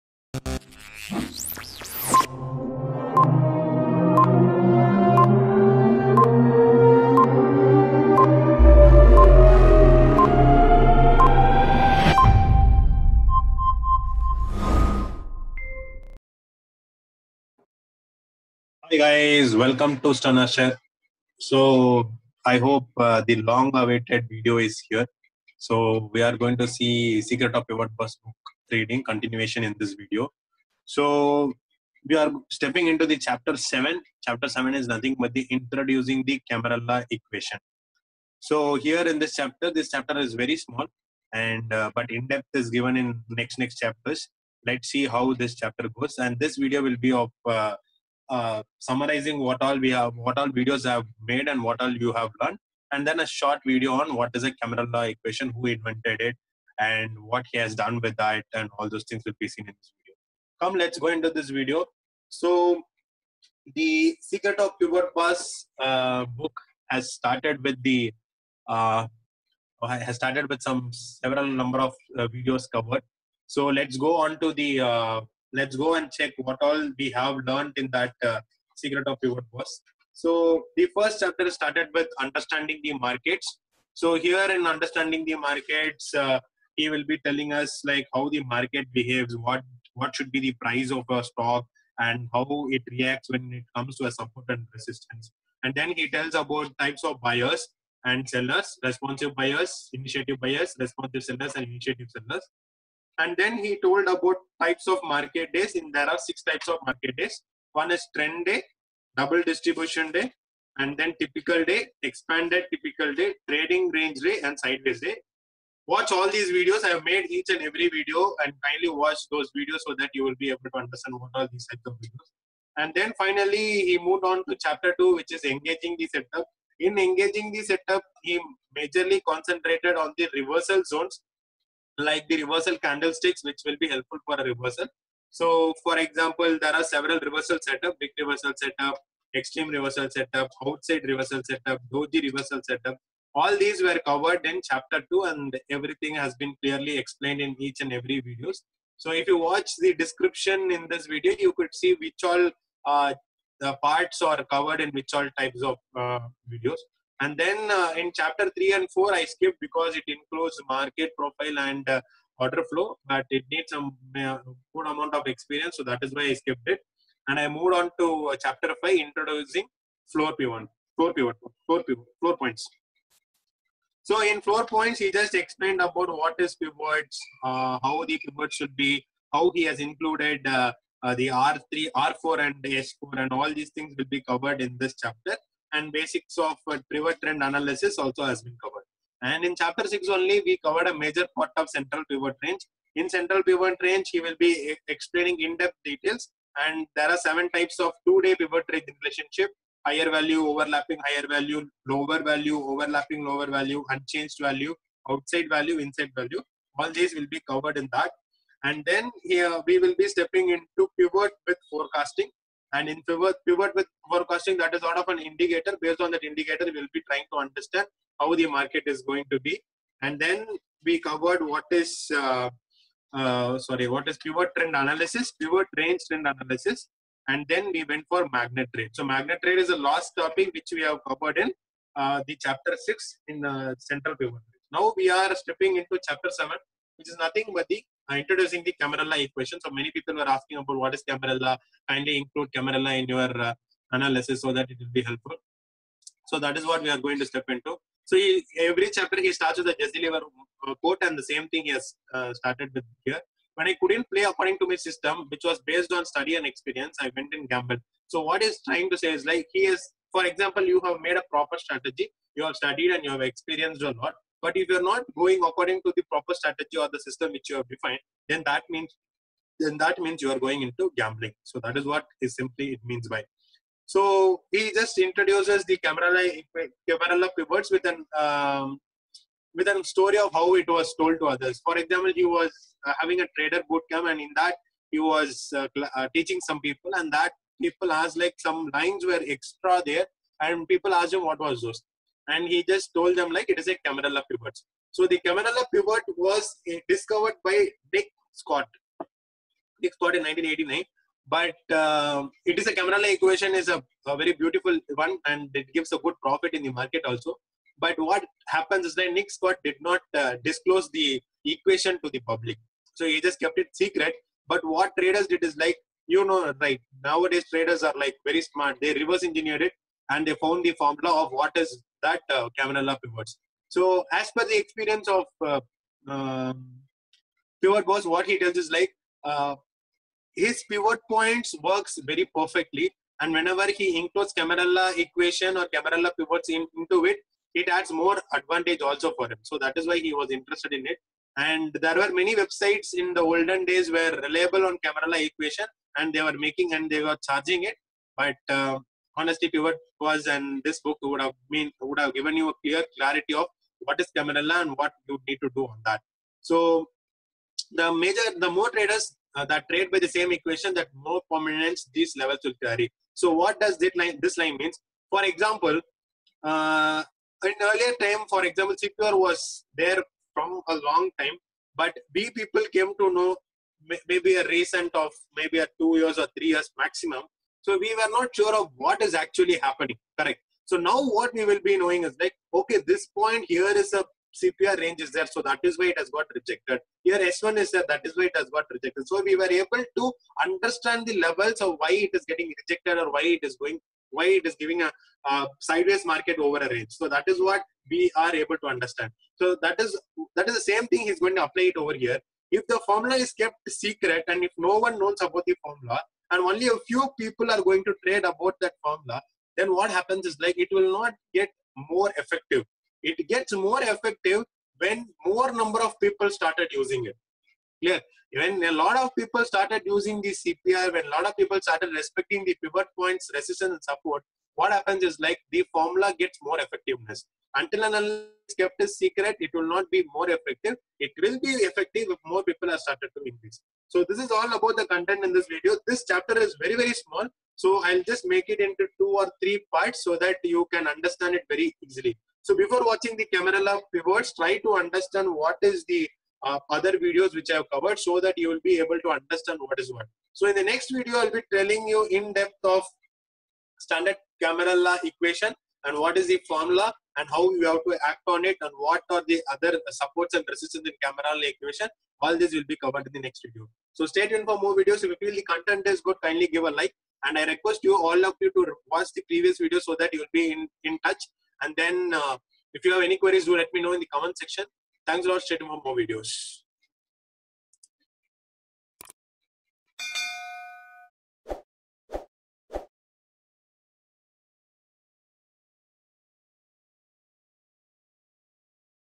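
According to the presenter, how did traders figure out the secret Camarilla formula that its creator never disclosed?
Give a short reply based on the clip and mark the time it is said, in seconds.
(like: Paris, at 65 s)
Reverse engineered it, at 318 s.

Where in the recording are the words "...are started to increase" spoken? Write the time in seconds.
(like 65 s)
432 s.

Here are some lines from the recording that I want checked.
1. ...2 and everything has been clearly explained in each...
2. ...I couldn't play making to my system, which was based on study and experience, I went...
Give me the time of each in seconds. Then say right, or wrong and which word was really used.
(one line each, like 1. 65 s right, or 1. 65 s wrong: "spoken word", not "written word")
1. 145 s right
2. 253 s wrong: "according", not "making".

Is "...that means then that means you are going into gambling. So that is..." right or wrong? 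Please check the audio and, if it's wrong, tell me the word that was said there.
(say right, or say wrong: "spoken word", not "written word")
right.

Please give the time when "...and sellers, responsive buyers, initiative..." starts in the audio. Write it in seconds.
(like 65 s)
98 s.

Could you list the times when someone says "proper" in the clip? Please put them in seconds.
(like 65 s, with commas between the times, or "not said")
261 s, 266 s.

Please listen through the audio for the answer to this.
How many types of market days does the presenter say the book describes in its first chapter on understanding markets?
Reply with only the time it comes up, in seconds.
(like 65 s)
106 s.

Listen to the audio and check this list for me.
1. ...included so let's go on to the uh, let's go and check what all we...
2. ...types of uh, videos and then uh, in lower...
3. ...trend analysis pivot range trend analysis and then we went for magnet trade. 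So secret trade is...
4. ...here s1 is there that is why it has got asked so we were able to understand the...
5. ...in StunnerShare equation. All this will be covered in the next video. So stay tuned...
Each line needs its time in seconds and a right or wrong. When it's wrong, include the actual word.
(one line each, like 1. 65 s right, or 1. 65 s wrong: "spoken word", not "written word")
1. 72 s wrong: "covered", not "included"
2. 155 s wrong: "chapter", not "lower"
3. 224 s wrong: "magnet", not "secret"
4. 387 s wrong: "rejected", not "asked"
5. 460 s wrong: "Camarilla", not "StunnerShare".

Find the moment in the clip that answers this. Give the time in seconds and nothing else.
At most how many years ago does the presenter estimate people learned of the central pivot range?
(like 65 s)
376 s.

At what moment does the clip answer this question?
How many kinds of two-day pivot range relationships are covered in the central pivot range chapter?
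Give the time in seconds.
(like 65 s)
197 s.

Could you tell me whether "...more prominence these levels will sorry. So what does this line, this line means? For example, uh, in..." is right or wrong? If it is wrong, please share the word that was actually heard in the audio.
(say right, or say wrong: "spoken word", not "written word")
wrong: "carry", not "sorry".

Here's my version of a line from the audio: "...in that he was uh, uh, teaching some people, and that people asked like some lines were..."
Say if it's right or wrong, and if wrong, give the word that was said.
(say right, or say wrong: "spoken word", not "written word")
right.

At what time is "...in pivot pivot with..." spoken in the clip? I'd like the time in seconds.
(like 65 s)
212 s.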